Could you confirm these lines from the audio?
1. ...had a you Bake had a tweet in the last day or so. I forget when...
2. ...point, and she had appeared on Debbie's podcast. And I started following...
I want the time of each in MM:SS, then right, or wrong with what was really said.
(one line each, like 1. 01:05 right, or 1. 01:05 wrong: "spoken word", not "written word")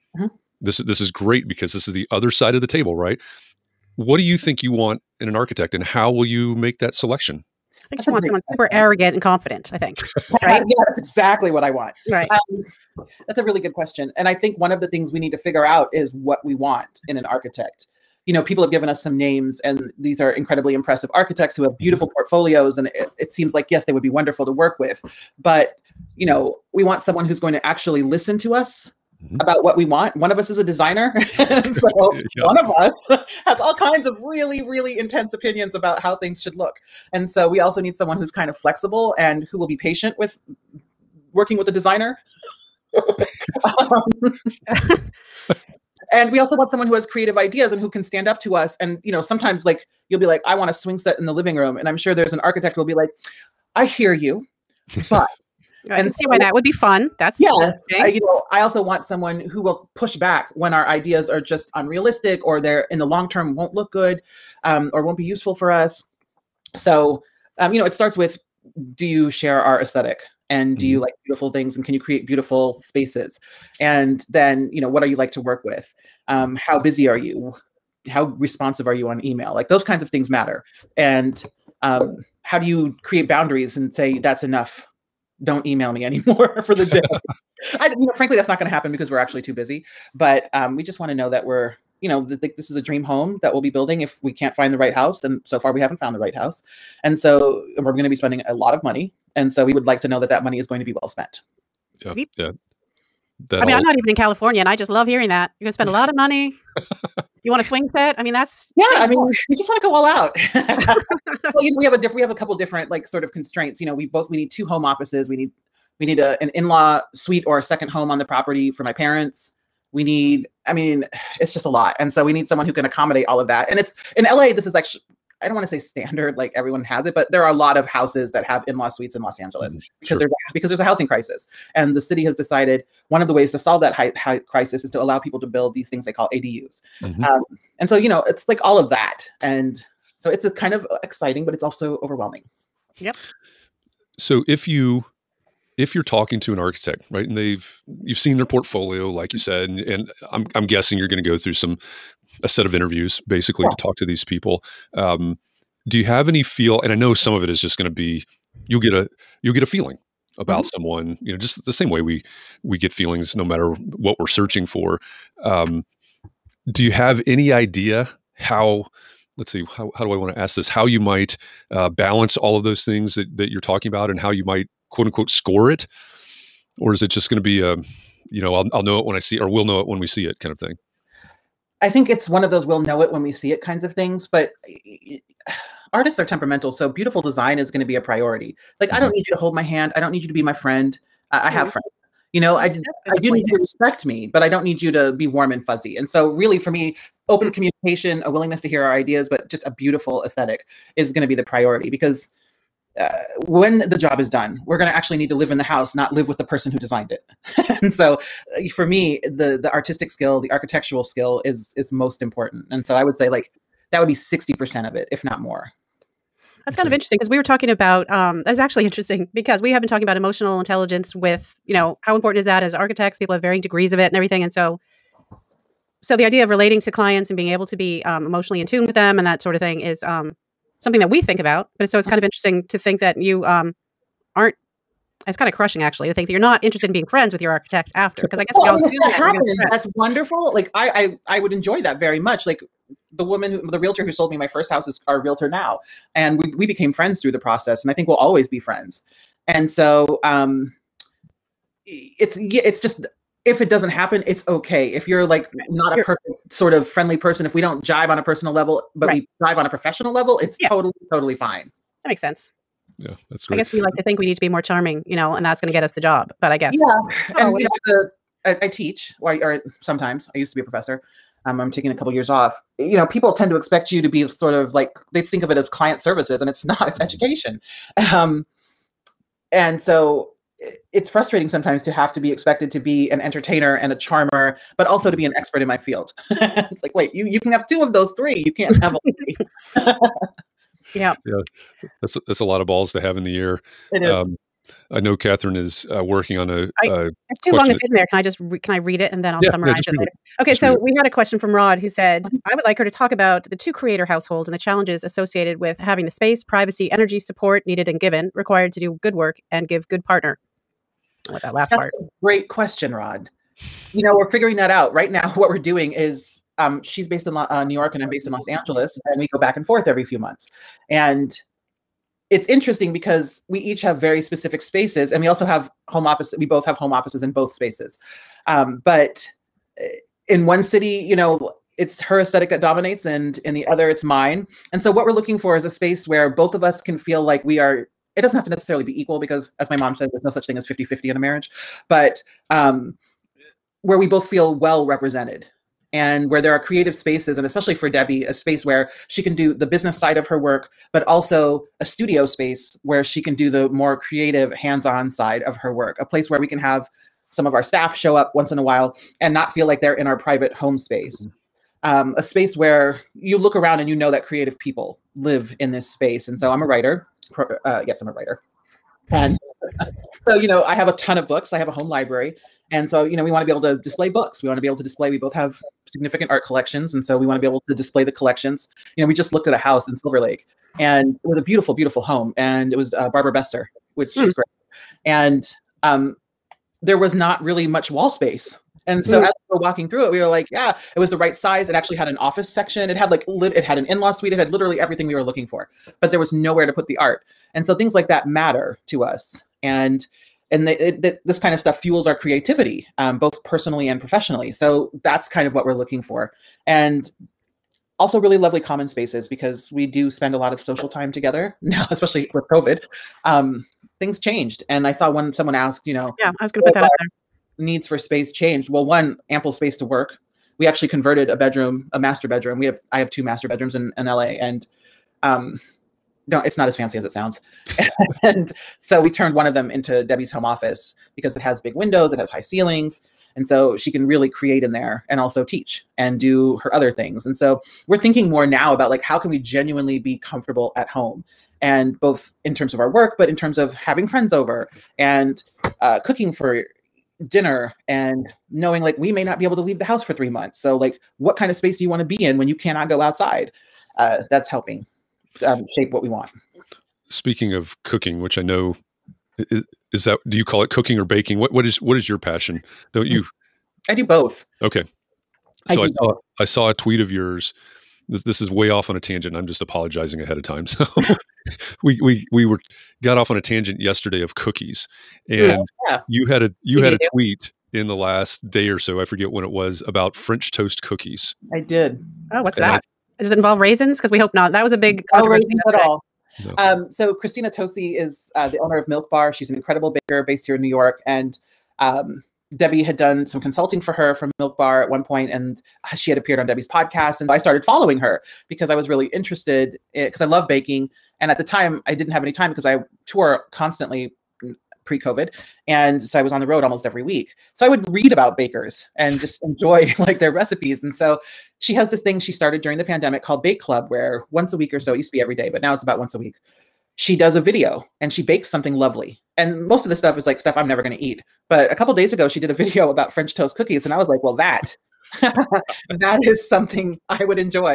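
1. 07:56 wrong: "Easy", not "Bake"
2. 08:15 right.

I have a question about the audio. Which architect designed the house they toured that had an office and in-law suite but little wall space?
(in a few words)
Barbara Bestor.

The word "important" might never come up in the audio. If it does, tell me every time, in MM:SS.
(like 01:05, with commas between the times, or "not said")
03:32, 03:42.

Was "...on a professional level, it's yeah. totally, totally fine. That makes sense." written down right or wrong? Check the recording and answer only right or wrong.
right.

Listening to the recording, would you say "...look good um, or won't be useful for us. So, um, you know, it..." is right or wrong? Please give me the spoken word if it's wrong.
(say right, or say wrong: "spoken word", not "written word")
right.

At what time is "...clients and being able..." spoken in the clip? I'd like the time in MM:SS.
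03:46.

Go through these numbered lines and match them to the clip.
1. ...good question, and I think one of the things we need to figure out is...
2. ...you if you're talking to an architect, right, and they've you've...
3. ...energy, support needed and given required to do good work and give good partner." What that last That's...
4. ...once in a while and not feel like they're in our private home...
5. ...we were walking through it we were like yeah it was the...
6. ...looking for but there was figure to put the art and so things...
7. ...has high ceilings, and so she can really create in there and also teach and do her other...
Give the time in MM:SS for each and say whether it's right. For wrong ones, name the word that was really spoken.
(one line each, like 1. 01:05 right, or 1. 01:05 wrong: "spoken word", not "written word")
1. 00:13 right
2. 02:24 right
3. 05:06 right
4. 05:58 right
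5. 06:29 right
6. 06:35 wrong: "nowhere", not "figure"
7. 07:12 right.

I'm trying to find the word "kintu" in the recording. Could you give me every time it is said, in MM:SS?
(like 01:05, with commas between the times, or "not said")
not said.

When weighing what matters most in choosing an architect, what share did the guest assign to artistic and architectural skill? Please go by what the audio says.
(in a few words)
60%.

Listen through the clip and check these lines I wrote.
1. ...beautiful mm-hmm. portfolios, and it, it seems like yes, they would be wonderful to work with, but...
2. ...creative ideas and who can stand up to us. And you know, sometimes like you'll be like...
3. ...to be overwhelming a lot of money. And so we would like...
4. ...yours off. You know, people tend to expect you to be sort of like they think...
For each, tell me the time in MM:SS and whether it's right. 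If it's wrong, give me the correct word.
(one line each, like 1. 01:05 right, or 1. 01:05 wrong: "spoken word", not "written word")
1. 00:21 right
2. 00:47 right
3. 01:38 wrong: "spending", not "overwhelming"
4. 04:32 wrong: "years", not "yours".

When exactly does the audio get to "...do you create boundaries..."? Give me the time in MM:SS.
01:22.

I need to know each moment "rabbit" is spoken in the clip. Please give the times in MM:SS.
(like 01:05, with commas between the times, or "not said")
not said.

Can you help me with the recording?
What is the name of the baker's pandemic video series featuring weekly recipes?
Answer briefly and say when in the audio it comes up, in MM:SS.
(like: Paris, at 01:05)
Bake Club, at 08:33.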